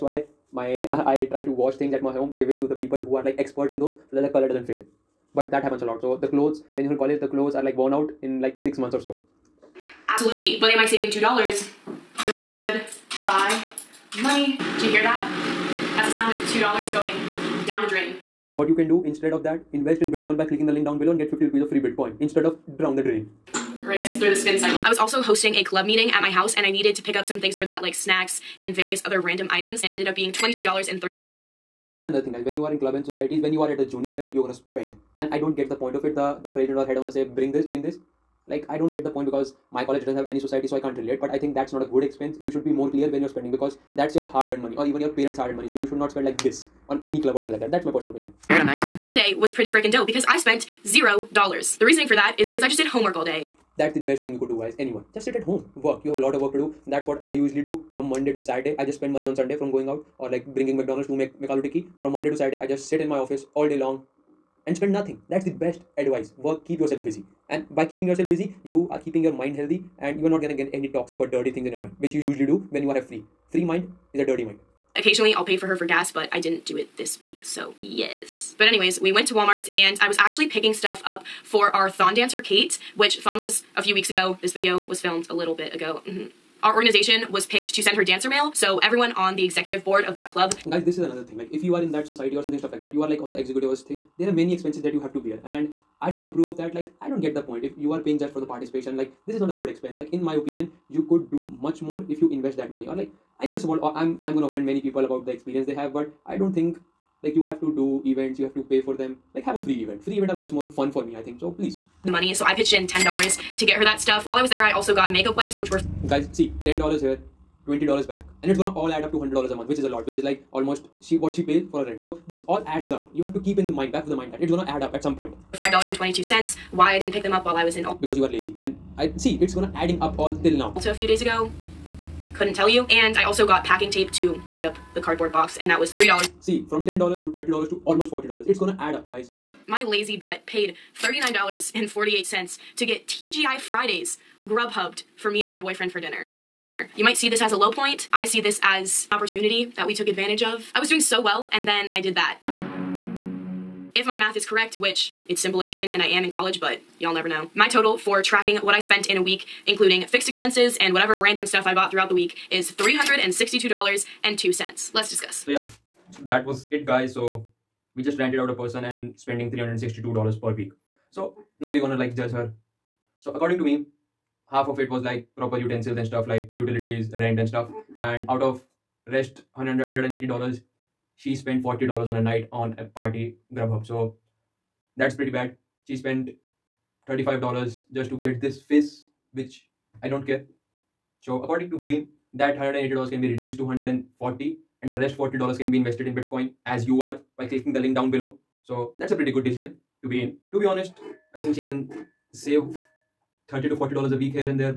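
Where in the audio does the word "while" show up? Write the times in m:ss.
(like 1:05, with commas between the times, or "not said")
1:54, 2:07.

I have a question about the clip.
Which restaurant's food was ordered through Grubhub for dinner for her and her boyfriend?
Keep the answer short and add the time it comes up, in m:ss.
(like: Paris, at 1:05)
TGI Fridays, at 2:23.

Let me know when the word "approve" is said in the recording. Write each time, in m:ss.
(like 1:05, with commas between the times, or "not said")
1:36.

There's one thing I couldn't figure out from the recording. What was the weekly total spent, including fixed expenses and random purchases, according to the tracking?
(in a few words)
$362.02.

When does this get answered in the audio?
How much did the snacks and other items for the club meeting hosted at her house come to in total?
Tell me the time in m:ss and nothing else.
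0:30.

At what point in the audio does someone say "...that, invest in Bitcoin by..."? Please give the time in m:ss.
0:19.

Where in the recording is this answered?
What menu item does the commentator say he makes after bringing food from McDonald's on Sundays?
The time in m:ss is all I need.
1:01.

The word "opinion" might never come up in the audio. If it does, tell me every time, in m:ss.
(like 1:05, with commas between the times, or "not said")
0:48, 1:40.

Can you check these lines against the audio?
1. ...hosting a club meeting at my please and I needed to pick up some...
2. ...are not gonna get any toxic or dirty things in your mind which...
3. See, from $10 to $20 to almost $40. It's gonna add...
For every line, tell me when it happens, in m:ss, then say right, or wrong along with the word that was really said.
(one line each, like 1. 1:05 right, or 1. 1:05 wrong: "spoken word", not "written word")
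1. 0:25 wrong: "house", not "please"
2. 1:10 right
3. 2:16 wrong: "30", not "20".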